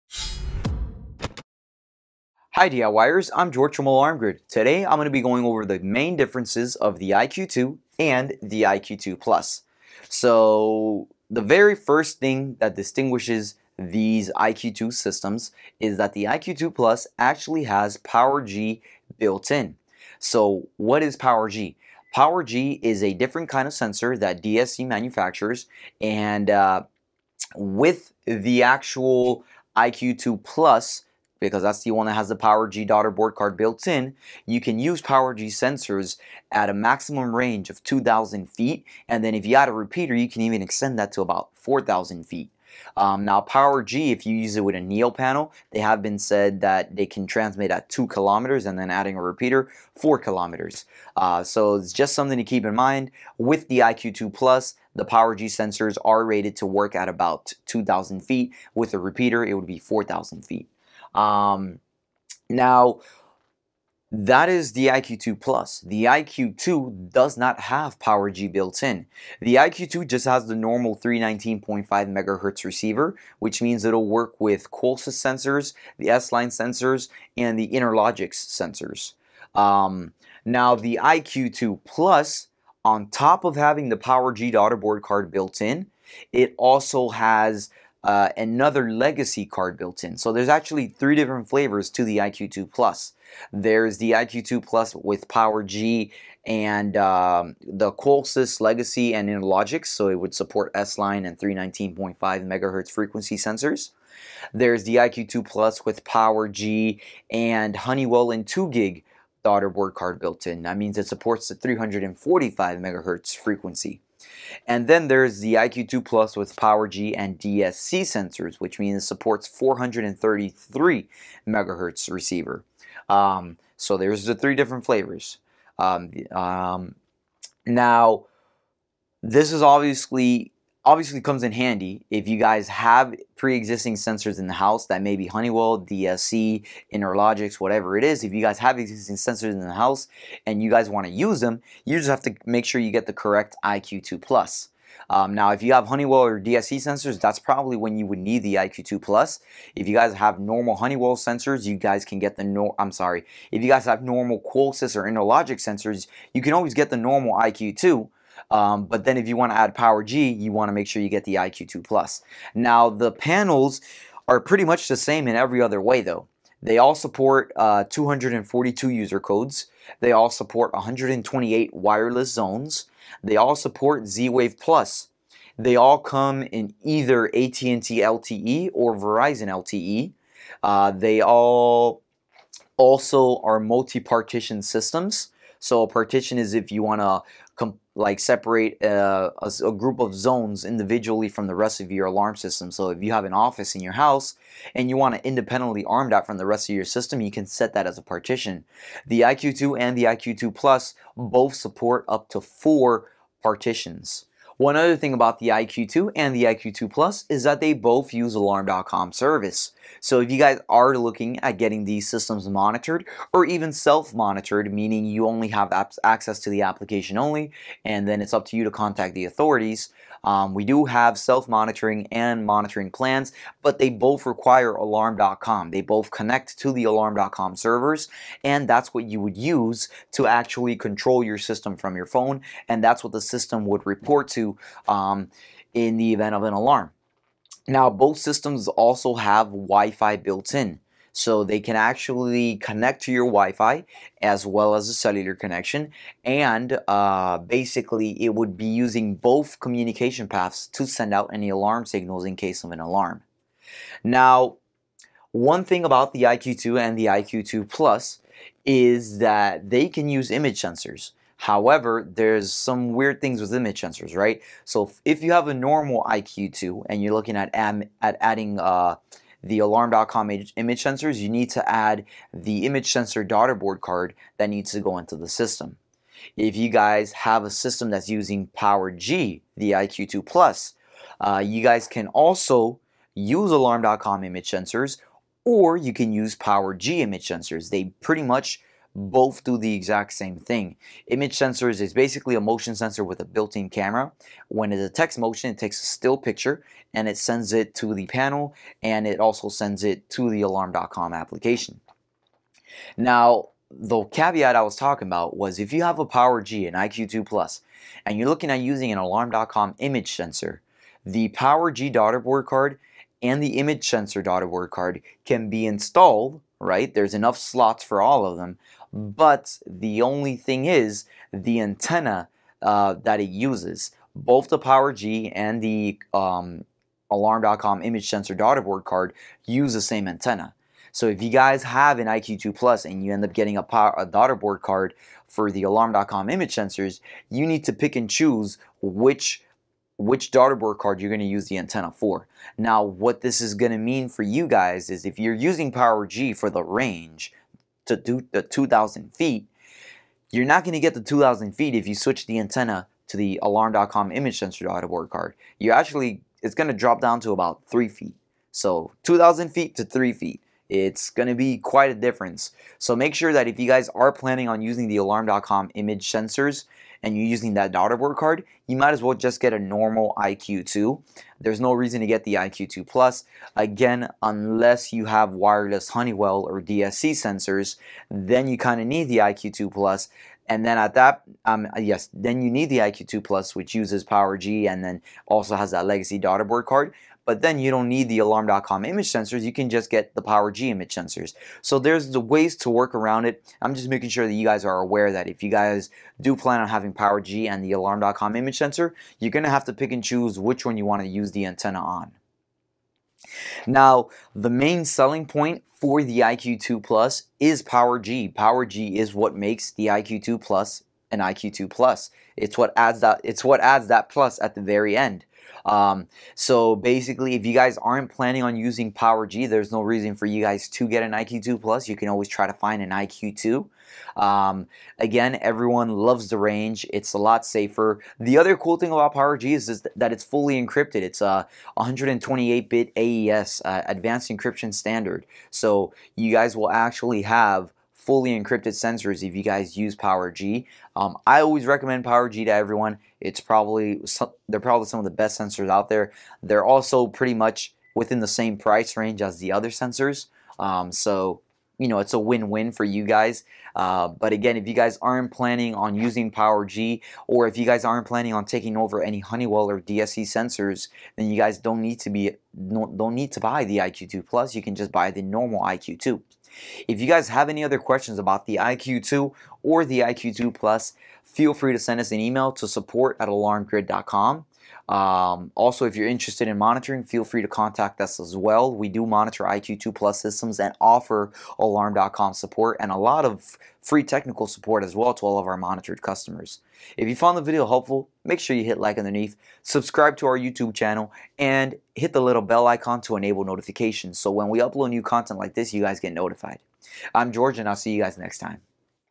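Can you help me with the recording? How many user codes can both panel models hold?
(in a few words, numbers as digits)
242.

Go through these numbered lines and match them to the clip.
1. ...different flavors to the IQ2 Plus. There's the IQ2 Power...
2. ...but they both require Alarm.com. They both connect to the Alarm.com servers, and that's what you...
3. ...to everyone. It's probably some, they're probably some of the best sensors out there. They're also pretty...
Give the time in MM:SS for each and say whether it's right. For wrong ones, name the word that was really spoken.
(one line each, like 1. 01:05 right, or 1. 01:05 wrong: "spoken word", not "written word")
1. 01:31 wrong: "Plus", not "Power"
2. 03:43 right
3. 07:22 right.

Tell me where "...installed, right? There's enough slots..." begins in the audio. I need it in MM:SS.
05:15.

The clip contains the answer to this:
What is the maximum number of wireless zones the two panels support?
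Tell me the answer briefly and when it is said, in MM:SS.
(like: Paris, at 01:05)
128, at 02:50.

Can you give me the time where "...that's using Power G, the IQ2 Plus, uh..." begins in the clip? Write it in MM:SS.
04:37.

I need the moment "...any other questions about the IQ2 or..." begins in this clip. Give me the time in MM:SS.
07:47.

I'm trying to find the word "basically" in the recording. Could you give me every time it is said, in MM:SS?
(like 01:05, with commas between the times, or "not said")
04:07, 04:51, 06:56.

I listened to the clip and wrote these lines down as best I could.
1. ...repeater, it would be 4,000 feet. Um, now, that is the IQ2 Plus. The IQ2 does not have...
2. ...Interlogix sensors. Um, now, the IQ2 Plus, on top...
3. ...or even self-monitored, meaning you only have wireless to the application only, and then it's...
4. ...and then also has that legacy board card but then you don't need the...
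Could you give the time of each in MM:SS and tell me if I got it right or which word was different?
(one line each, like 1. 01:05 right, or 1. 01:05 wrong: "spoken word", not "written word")
1. 00:58 right
2. 01:17 right
3. 03:33 wrong: "access", not "wireless"
4. 06:24 wrong: "daughterboard", not "board".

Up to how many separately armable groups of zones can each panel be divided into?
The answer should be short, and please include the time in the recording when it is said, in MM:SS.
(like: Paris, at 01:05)
4, at 03:22.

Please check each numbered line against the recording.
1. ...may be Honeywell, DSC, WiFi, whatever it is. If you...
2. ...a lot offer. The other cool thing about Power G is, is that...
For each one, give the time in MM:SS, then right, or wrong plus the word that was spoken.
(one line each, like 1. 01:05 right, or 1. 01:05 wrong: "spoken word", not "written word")
1. 02:15 wrong: "Interlogix", not "WiFi"
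2. 07:07 wrong: "safer", not "offer".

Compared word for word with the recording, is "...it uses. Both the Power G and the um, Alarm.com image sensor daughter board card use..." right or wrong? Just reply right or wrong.
right.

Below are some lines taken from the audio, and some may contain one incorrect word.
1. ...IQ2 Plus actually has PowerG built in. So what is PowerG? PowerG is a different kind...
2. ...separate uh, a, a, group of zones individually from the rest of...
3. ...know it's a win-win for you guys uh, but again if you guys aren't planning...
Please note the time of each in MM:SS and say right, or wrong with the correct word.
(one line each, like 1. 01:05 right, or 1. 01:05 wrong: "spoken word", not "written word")
1. 00:16 right
2. 03:08 right
3. 07:31 right.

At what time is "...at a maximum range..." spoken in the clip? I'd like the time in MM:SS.
00:36.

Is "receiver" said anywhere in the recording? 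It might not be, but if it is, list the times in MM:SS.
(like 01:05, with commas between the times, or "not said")
01:12, 02:02.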